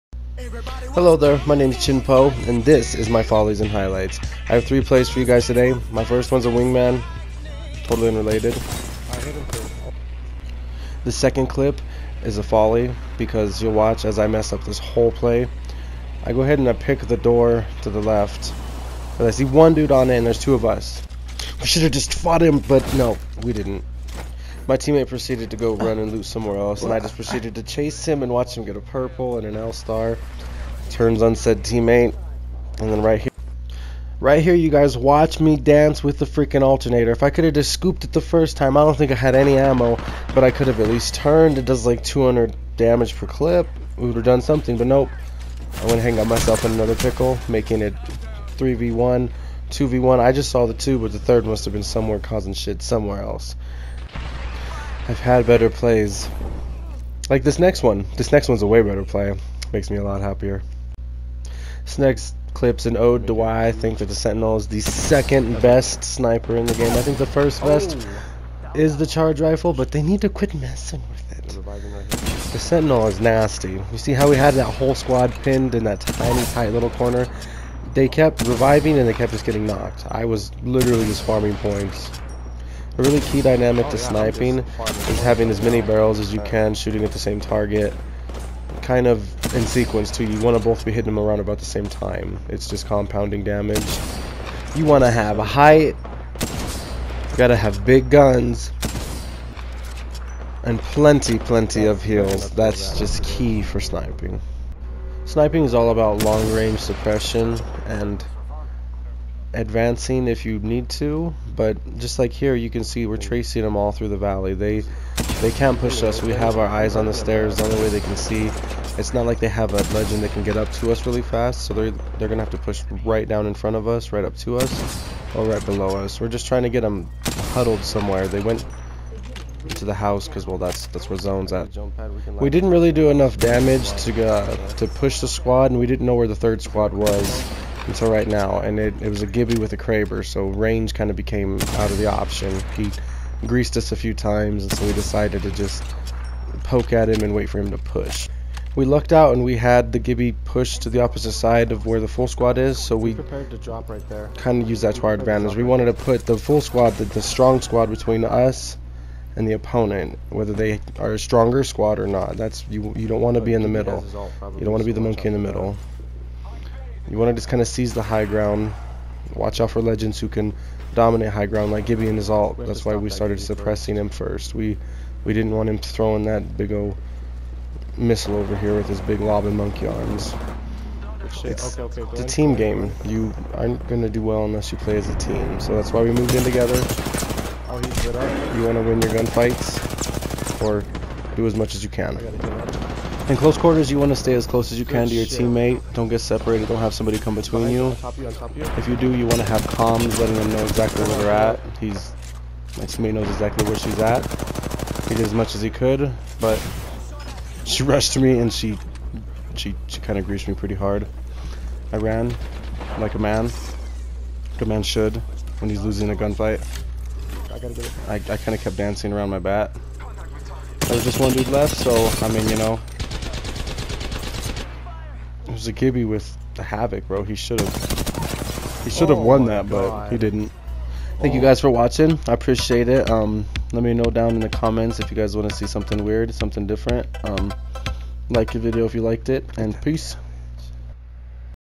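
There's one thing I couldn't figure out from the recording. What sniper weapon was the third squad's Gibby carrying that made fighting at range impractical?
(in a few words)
Kraber.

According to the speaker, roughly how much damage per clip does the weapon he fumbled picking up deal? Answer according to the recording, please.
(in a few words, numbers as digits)
200.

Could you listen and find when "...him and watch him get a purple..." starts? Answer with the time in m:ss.
0:28.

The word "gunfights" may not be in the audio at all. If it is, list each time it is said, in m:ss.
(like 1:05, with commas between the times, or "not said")
3:09, 3:36.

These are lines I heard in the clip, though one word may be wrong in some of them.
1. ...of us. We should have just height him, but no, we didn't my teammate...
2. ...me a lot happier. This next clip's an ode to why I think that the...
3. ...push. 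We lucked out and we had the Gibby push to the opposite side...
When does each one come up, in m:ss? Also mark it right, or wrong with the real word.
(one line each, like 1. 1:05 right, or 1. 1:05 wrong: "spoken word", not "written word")
1. 0:20 wrong: "fought", not "height"
2. 0:59 right
3. 2:27 right.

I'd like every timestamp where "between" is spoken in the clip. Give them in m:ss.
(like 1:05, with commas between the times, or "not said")
2:37, 3:17.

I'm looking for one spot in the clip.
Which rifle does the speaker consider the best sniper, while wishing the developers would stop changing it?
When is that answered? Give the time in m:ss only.
1:09.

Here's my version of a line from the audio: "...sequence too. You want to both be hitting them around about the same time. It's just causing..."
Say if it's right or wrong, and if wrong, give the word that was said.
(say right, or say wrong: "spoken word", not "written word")
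wrong: "compounding", not "causing".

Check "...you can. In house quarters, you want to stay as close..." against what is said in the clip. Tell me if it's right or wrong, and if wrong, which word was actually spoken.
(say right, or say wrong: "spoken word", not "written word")
wrong: "close", not "house".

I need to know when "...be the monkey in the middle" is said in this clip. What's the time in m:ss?
2:44.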